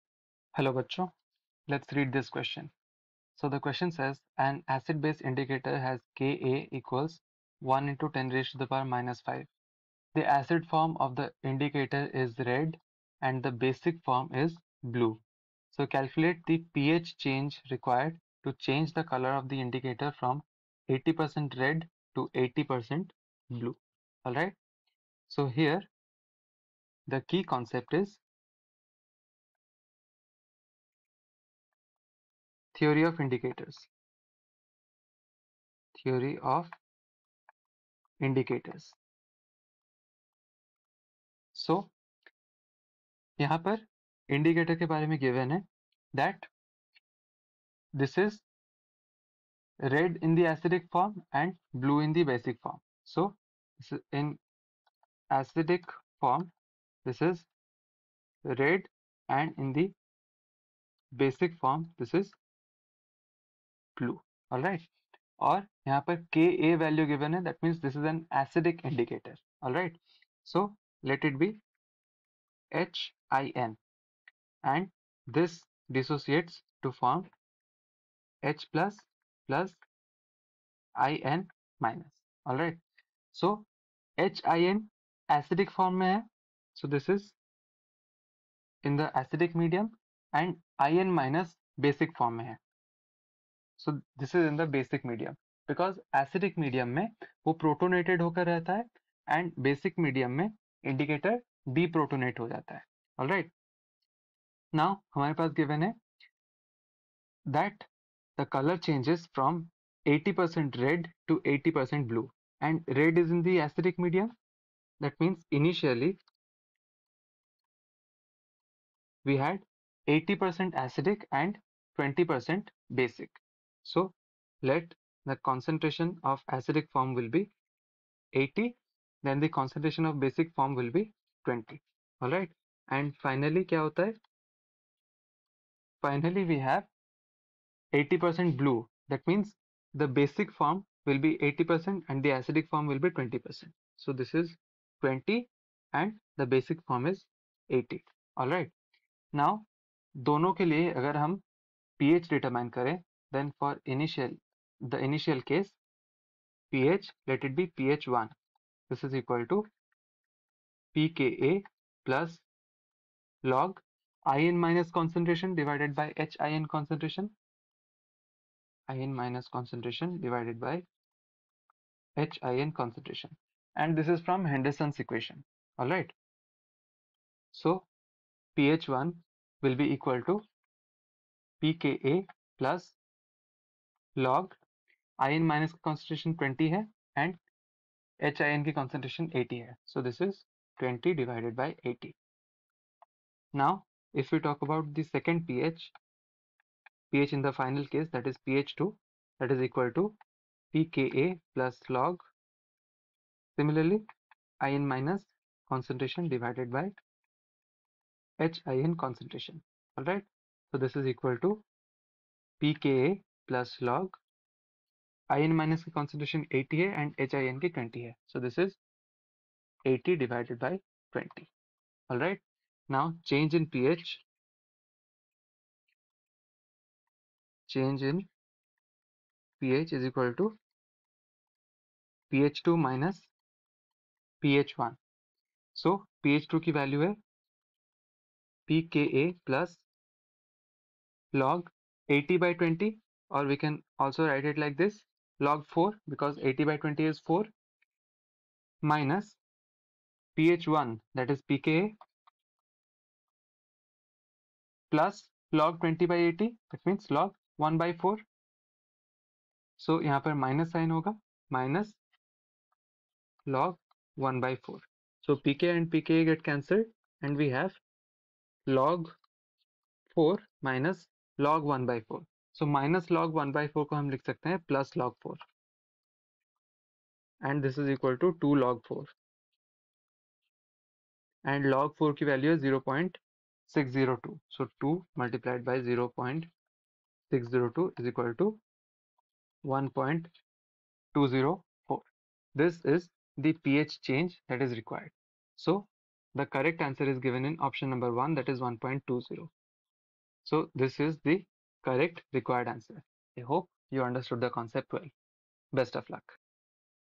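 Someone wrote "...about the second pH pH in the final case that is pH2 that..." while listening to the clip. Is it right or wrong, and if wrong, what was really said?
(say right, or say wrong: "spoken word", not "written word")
right.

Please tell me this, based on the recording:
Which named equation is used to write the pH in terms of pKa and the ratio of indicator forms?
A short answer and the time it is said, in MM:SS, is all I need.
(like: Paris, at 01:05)
Henderson's equation, at 02:54.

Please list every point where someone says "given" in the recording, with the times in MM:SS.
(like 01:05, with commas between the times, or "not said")
04:57.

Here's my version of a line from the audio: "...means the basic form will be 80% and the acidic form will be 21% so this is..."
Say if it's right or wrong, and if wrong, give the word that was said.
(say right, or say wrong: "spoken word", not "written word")
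wrong: "20", not "21".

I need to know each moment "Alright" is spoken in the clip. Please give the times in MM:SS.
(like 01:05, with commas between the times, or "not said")
00:24, 02:55.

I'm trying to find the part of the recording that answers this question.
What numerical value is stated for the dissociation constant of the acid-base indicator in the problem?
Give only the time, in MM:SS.
00:07.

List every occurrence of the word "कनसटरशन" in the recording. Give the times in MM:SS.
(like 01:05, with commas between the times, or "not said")
03:06, 03:35.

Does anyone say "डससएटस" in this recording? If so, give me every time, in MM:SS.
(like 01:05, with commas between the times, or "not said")
01:15.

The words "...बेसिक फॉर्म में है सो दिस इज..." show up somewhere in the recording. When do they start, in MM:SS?
01:31.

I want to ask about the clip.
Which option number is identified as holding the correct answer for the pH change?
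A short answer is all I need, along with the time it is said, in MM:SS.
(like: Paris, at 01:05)
1, at 04:57.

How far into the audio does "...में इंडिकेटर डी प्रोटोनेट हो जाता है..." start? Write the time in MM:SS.
01:40.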